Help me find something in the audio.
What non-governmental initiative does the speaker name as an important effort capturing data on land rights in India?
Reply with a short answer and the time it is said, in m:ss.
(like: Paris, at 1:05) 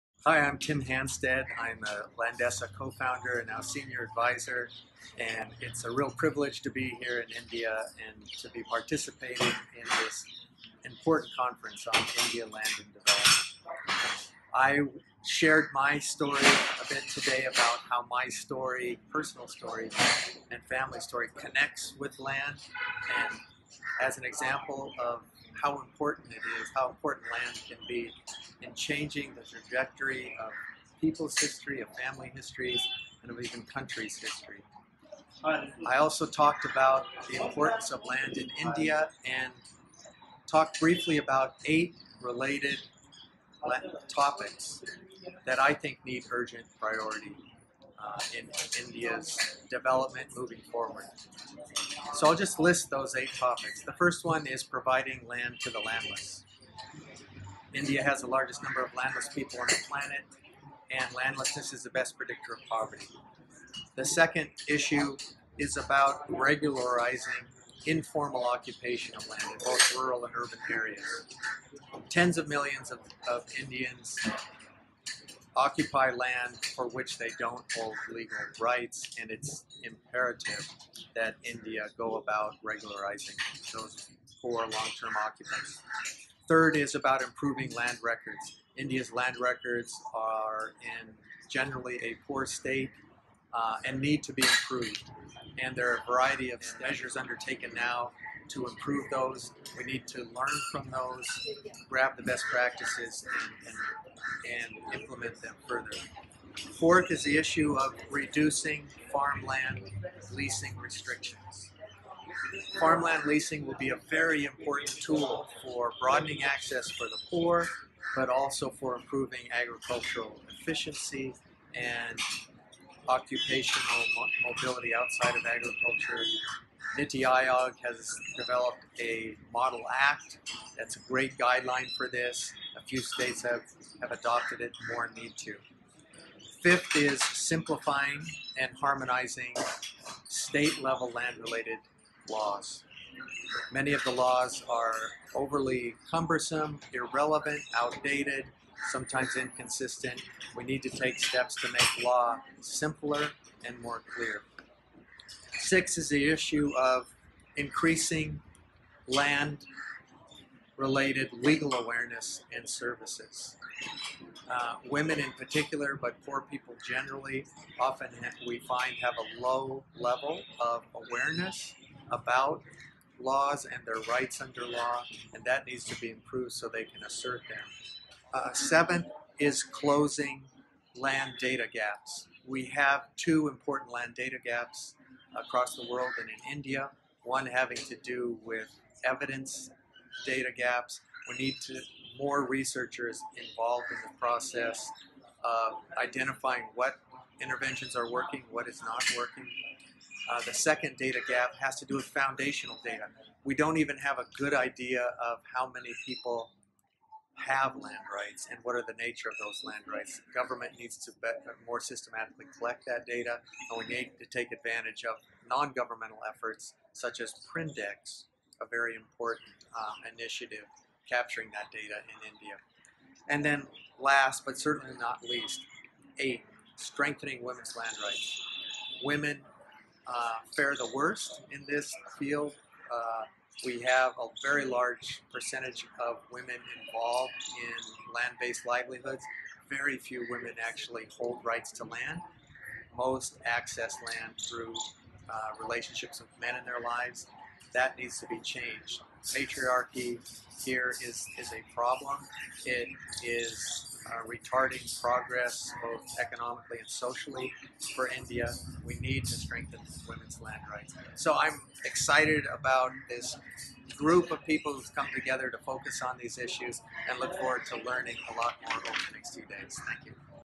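Prindex, at 3:37.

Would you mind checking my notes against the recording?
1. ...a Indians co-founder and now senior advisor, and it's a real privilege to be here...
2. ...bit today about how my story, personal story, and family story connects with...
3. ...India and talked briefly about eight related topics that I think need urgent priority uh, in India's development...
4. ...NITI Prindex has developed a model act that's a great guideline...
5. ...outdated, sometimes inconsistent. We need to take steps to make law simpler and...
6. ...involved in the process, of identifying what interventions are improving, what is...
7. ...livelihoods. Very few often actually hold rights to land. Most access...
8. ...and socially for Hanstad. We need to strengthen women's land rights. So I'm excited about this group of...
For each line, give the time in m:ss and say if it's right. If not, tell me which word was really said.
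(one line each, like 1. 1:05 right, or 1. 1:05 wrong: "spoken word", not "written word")
1. 0:01 wrong: "Landesa", not "Indians"
2. 0:16 right
3. 0:38 right
4. 2:06 wrong: "Aayog", not "Prindex"
5. 2:27 right
6. 3:13 wrong: "working", not "improving"
7. 3:58 wrong: "women", not "often"
8. 4:16 wrong: "India", not "Hanstad".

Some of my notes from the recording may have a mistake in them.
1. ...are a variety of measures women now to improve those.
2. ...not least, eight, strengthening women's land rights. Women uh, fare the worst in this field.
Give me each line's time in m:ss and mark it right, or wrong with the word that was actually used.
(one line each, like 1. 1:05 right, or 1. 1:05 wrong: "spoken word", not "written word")
1. 1:35 wrong: "undertaken", not "women"
2. 3:44 right.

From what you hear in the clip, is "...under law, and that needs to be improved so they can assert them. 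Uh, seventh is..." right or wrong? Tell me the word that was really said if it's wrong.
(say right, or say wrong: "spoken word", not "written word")
right.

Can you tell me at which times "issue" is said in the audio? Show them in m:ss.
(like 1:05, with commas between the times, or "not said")
1:04, 1:47, 2:36, 4:26.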